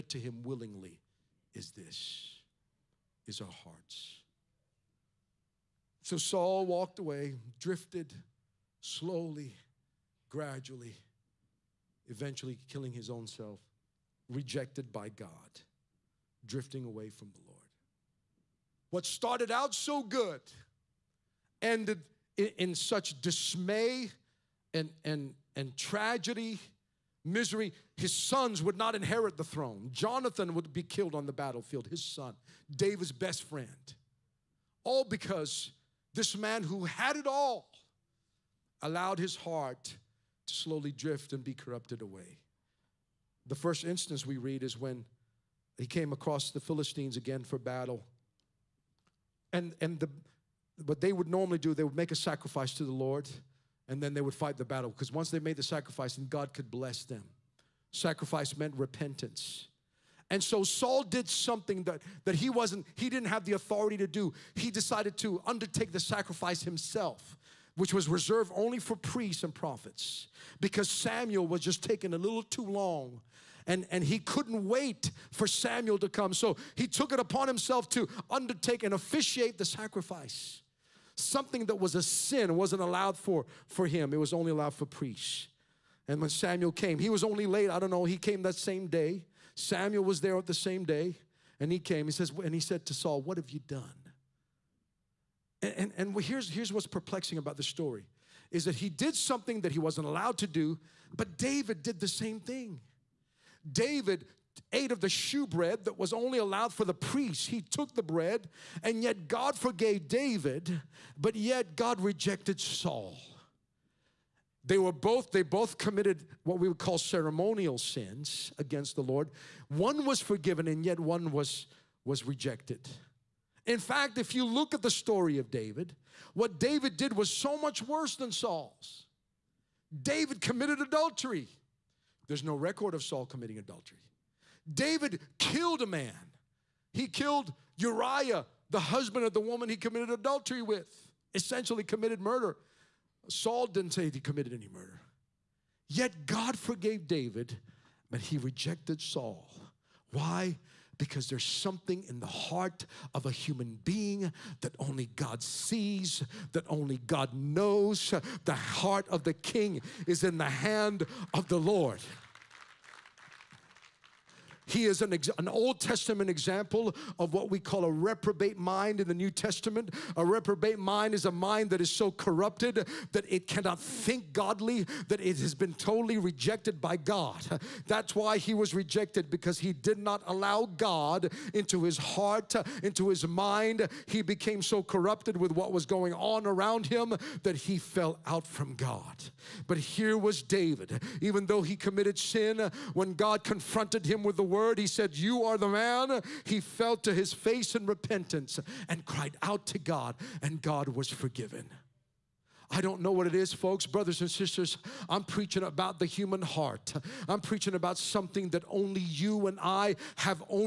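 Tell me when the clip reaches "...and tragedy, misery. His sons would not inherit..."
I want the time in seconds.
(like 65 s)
25 s.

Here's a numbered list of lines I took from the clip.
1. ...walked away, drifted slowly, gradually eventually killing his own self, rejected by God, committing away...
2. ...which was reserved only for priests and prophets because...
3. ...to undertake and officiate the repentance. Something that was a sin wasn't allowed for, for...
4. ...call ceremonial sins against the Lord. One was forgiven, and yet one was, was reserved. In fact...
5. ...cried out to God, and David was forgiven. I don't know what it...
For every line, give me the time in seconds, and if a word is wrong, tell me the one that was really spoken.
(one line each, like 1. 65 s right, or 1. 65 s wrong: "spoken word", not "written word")
1. 6 s wrong: "drifting", not "committing"
2. 67 s right
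3. 77 s wrong: "sacrifice", not "repentance"
4. 116 s wrong: "rejected", not "reserved"
5. 199 s wrong: "God", not "David".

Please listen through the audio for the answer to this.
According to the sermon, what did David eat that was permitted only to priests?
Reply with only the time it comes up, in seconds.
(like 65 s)
105 s.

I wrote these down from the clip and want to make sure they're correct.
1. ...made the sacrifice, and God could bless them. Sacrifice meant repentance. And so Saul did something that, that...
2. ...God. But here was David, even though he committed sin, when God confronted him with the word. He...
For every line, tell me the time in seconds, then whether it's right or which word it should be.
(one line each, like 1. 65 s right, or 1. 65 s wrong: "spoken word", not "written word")
1. 55 s right
2. 188 s right.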